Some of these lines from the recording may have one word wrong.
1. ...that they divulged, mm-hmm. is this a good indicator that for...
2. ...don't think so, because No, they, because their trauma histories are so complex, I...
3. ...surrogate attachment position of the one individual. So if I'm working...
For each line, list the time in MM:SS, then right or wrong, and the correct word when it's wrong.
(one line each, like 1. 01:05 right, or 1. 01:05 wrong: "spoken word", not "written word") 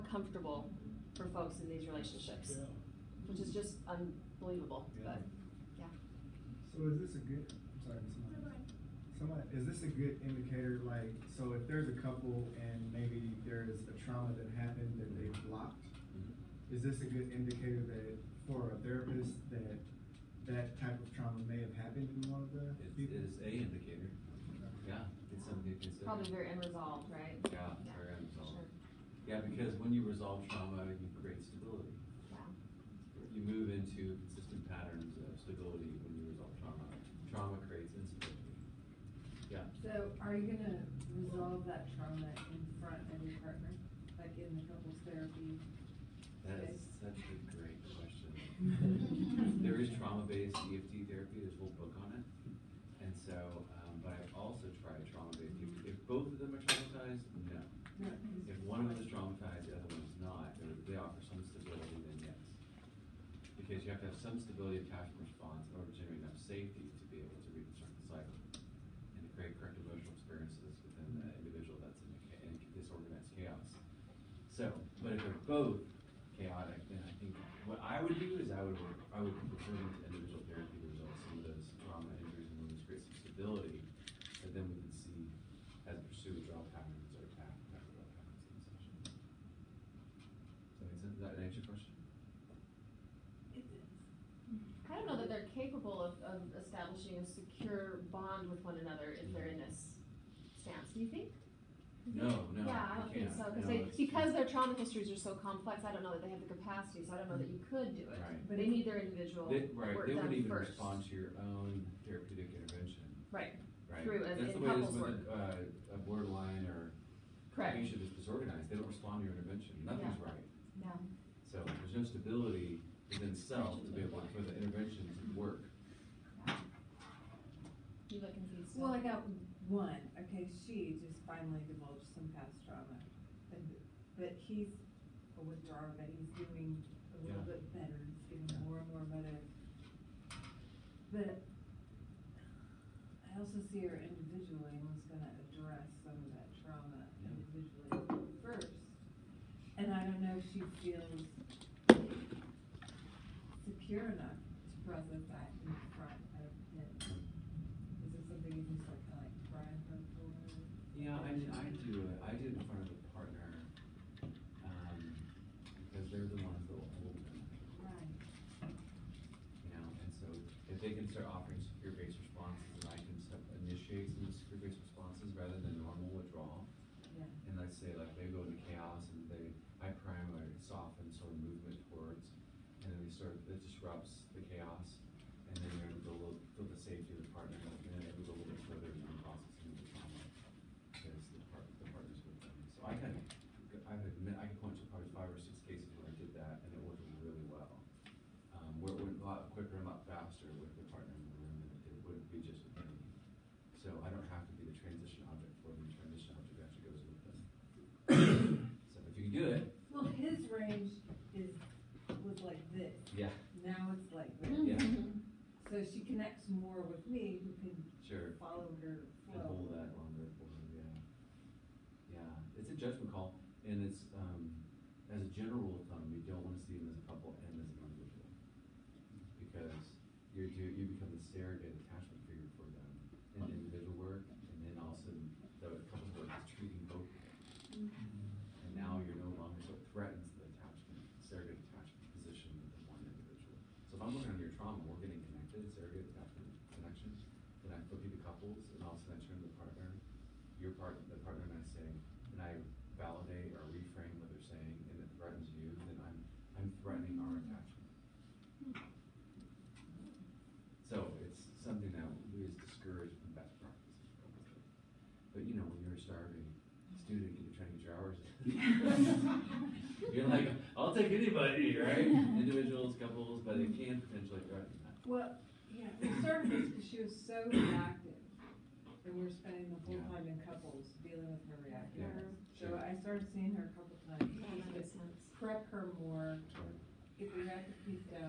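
1. 00:15 wrong: "blocked", not "divulged"
2. 01:42 right
3. 04:01 right.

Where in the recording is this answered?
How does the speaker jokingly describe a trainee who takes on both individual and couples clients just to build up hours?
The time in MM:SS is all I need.
04:26.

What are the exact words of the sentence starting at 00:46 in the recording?
That is such a great question.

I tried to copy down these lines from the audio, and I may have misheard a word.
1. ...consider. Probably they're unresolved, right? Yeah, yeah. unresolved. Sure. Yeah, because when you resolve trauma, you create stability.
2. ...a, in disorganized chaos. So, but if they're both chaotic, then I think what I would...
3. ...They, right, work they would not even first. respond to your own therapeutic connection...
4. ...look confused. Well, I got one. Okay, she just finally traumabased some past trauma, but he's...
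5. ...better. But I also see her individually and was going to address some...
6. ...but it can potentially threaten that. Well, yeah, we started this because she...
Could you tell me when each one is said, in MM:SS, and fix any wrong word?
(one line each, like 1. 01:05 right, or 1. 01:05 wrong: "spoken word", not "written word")
1. 00:25 right
2. 01:12 right
3. 01:49 wrong: "intervention", not "connection"
4. 02:08 wrong: "divulged", not "traumabased"
5. 02:19 right
6. 04:33 right.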